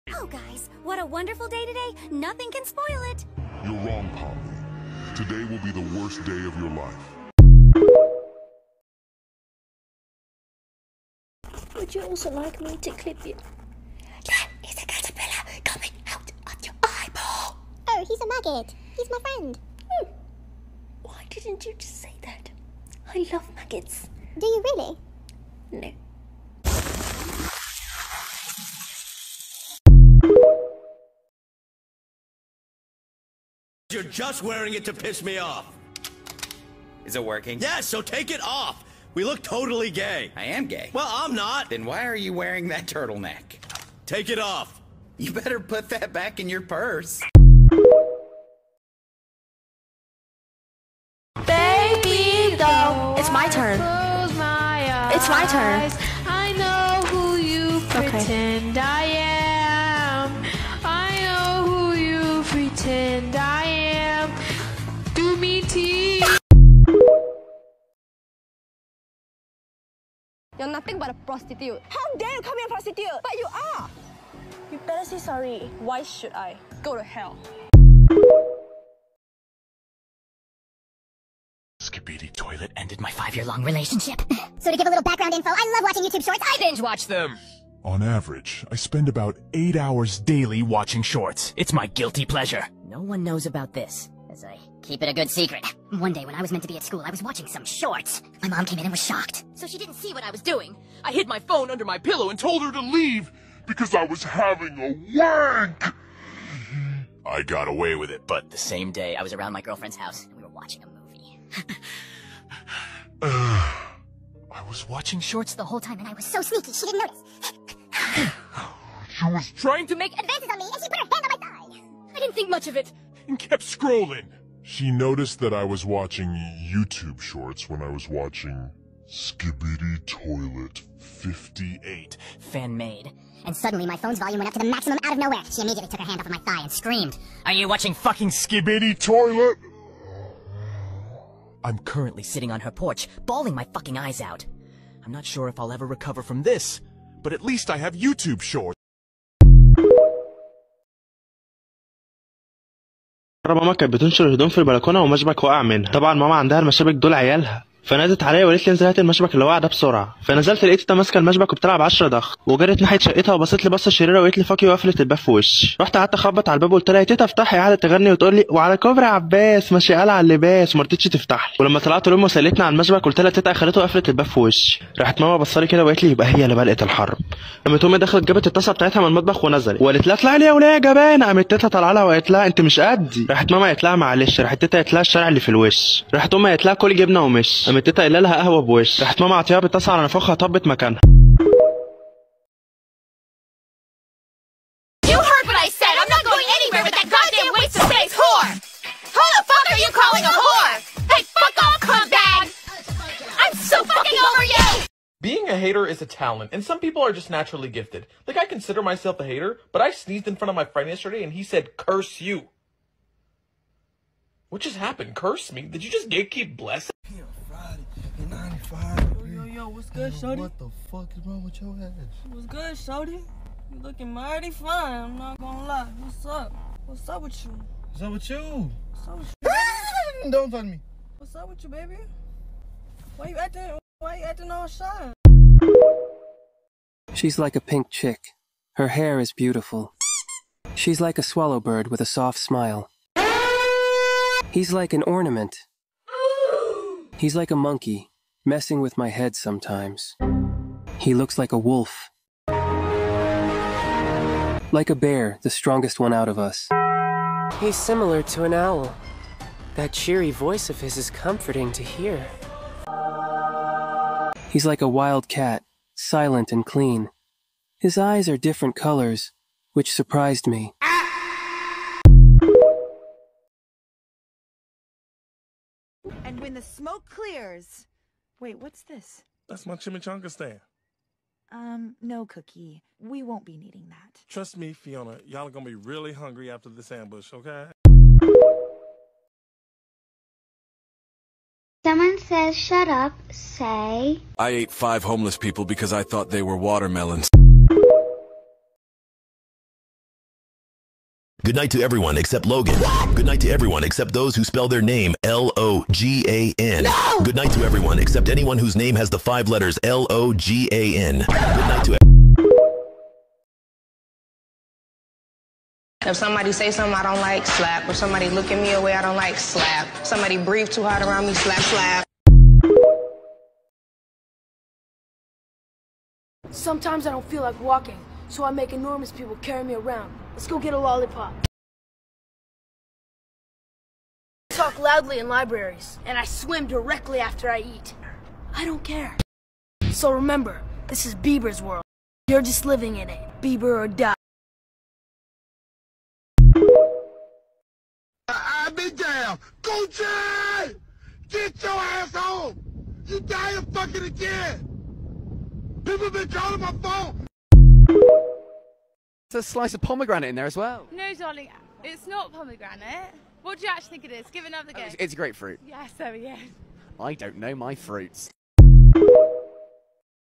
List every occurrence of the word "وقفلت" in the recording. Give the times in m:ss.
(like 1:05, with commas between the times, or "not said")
2:44, 2:53.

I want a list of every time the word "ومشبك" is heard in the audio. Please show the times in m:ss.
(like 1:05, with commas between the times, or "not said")
2:35.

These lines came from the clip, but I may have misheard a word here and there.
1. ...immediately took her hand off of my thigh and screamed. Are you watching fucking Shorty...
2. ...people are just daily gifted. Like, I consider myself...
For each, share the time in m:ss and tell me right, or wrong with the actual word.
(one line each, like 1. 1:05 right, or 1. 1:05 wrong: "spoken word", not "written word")
1. 2:15 wrong: "Skibidi", not "Shorty"
2. 3:26 wrong: "naturally", not "daily".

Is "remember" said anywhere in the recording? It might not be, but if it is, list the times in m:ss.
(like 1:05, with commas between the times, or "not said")
5:40.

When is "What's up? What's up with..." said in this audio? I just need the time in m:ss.
3:46.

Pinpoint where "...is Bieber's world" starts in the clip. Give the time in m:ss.
5:41.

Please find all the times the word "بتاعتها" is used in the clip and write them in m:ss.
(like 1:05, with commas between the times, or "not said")
2:58.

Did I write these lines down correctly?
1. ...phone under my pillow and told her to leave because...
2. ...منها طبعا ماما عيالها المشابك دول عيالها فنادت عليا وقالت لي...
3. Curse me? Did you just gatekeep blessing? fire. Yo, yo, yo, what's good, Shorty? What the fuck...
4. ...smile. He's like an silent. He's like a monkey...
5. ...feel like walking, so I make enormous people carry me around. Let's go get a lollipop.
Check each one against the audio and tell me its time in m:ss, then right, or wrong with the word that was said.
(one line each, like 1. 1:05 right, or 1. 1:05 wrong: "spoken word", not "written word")
1. 1:41 right
2. 2:35 wrong: "عندها", not "عيالها"
3. 3:35 right
4. 4:02 wrong: "ornament", not "silent"
5. 5:27 right.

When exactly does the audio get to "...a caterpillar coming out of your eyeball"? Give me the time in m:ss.
0:14.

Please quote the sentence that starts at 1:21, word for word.
Skibidi Toilet ended my five-year-long relationship.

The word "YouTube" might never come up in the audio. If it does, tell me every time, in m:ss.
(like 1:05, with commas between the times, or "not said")
1:26, 2:06, 2:27.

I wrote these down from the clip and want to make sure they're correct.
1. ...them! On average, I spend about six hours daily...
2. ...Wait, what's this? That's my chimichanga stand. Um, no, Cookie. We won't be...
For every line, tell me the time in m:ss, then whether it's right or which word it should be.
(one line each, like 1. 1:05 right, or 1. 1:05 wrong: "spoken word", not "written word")
1. 1:27 wrong: "eight", not "six"
2. 4:38 right.